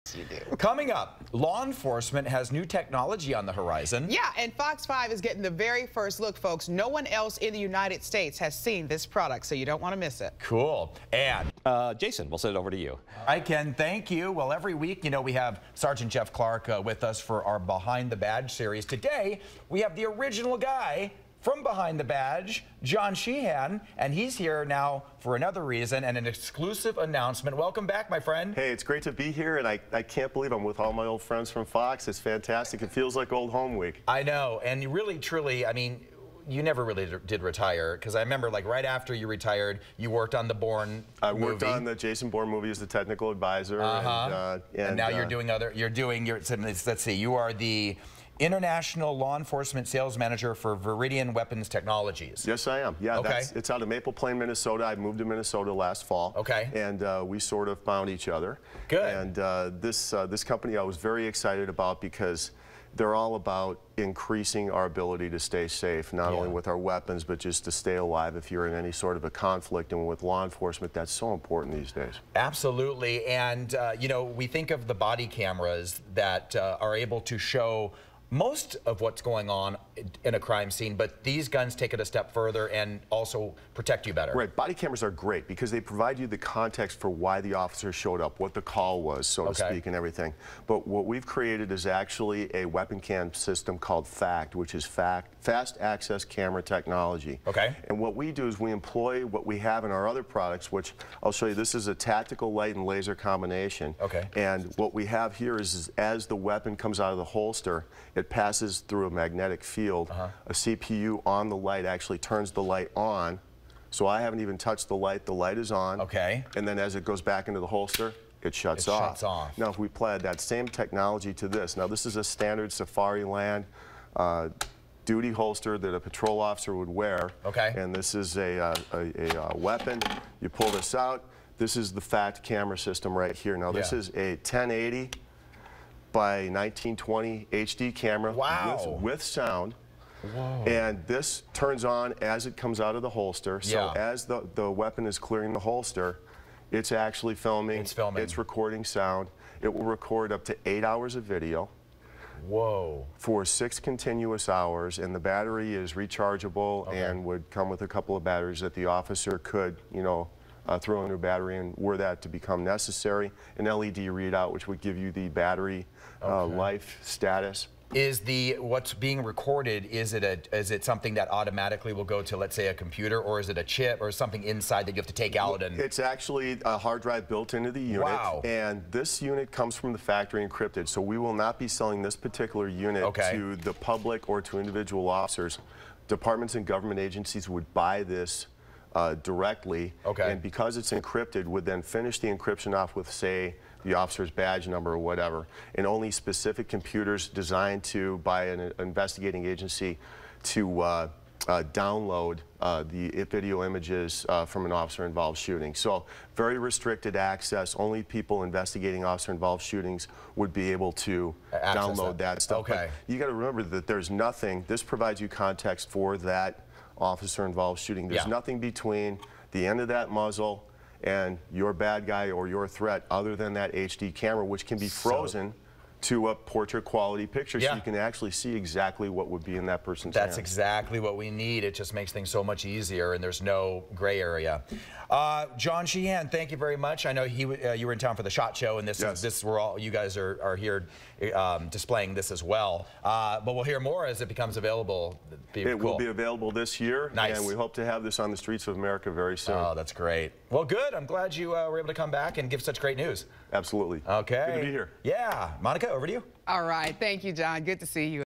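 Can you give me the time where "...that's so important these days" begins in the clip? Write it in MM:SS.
01:10.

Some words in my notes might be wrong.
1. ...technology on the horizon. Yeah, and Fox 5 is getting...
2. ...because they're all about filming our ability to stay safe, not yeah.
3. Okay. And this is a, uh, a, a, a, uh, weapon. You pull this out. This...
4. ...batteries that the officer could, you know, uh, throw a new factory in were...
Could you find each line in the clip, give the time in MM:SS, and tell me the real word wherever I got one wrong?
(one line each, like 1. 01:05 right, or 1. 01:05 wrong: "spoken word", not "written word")
1. 00:02 right
2. 01:02 wrong: "increasing", not "filming"
3. 02:07 right
4. 02:38 wrong: "battery", not "factory".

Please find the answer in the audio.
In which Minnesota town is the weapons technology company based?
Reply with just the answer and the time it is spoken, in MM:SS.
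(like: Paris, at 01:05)
Maple Plain, at 00:53.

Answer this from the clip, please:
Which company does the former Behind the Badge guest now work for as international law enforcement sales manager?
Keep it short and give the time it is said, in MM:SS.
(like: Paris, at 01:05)
Viridian Weapons Technologies, at 00:50.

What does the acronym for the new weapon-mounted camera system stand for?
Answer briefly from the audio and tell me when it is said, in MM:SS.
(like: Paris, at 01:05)
Fast Access Camera Technology, at 01:35.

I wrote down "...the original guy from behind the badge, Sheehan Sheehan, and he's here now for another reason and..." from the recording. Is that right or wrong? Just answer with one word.
wrong.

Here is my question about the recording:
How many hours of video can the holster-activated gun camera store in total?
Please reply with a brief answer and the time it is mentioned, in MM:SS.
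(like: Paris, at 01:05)
8, at 02:30.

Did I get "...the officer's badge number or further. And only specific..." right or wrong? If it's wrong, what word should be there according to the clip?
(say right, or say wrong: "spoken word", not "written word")
wrong: "whatever", not "further".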